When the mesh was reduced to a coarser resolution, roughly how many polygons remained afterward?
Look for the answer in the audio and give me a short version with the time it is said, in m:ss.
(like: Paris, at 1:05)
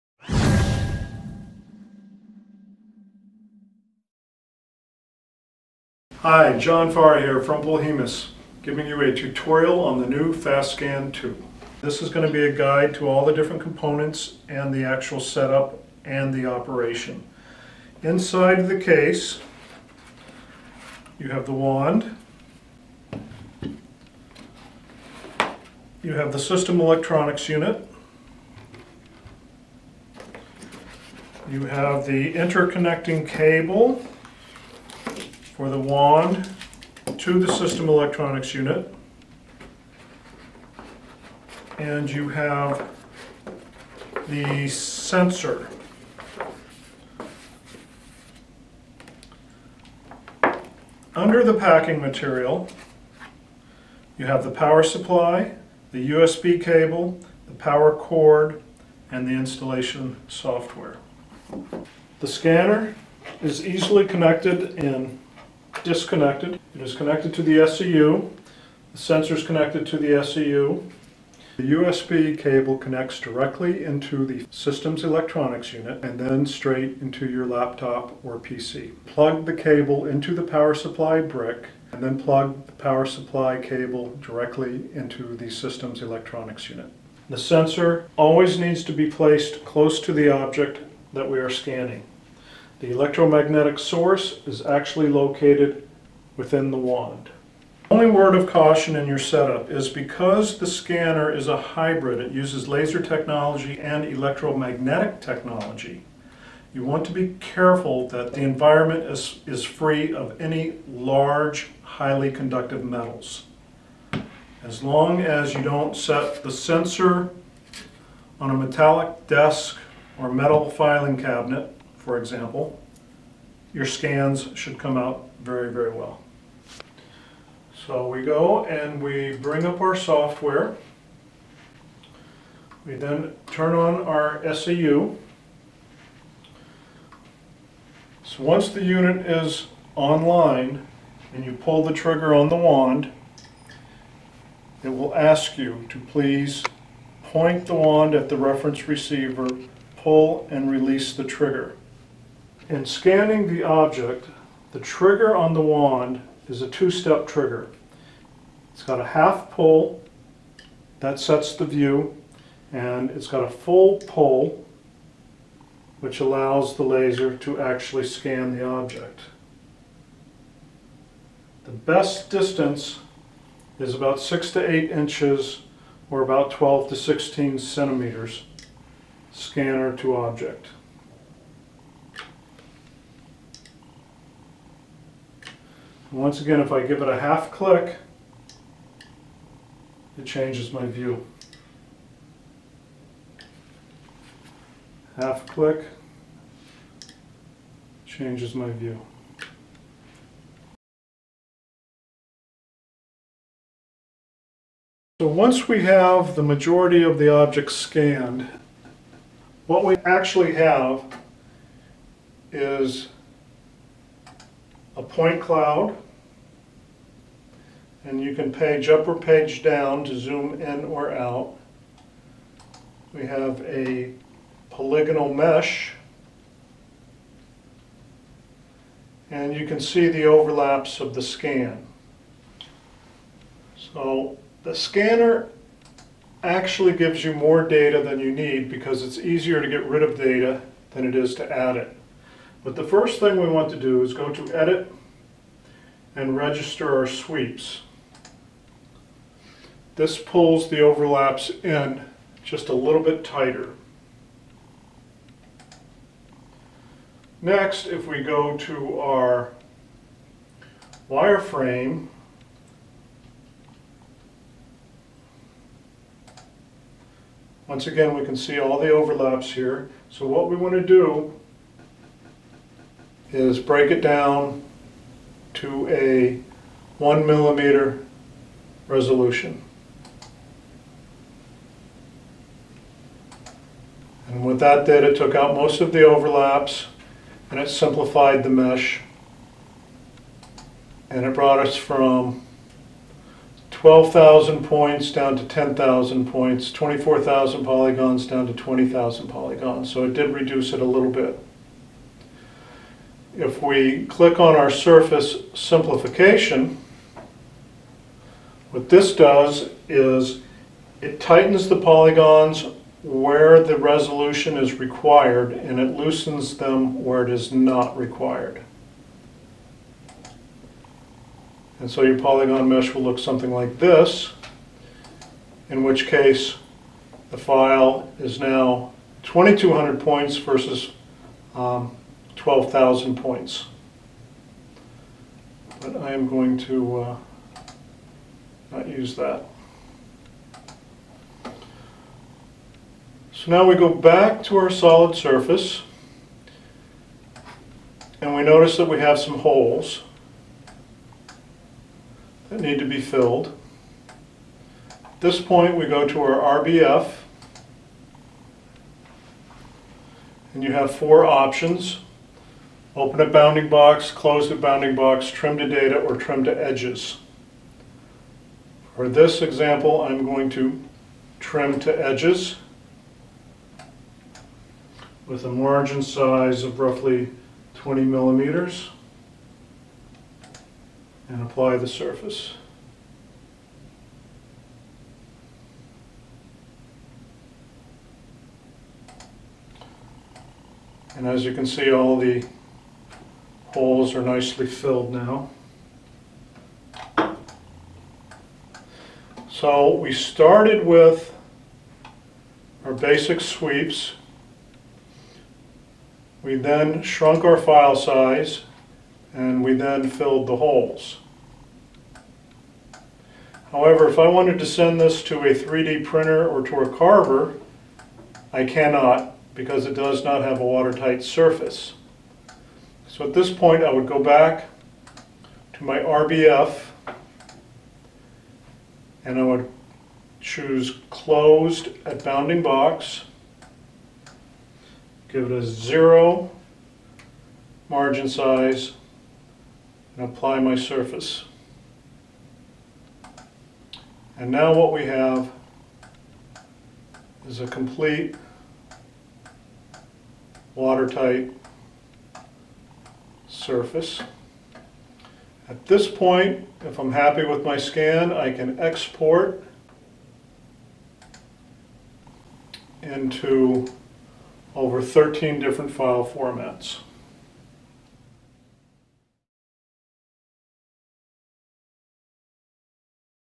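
20,000 polygons, at 4:58.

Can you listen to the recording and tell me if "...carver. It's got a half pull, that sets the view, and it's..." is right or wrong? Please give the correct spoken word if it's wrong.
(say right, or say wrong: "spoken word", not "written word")
wrong: "trigger", not "carver".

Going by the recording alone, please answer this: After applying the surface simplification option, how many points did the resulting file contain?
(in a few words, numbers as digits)
2200 points.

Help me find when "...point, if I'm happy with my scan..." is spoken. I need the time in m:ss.
7:36.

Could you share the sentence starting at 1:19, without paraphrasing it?
Plug the cable into the power supply brick and then plug the power supply cable directly into the system's electronics unit.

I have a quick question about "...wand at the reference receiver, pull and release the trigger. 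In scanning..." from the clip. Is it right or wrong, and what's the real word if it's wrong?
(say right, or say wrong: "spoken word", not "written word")
right.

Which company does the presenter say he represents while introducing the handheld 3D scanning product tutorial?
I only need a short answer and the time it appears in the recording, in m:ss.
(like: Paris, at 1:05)
Polhemus, at 0:07.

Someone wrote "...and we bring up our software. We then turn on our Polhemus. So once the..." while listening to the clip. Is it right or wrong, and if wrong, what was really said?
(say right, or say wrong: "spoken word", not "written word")
wrong: "SEU", not "Polhemus".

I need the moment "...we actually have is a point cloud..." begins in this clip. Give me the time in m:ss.
3:29.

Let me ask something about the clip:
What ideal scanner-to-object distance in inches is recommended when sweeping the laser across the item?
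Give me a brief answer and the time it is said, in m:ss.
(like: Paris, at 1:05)
6 to 8 inches, at 2:54.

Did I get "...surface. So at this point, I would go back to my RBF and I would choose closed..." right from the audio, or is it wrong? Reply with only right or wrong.
right.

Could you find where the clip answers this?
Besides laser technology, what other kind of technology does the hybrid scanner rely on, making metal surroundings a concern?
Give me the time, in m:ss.
1:44.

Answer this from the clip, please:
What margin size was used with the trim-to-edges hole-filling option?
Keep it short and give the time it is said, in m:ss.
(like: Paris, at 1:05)
20 millimeters, at 6:17.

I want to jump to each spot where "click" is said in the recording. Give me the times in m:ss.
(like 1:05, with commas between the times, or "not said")
3:07, 3:15, 5:04.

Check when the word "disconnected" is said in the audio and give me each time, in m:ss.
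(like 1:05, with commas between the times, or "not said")
1:05.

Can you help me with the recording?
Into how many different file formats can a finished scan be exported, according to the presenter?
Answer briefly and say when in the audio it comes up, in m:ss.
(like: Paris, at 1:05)
over 13, at 7:44.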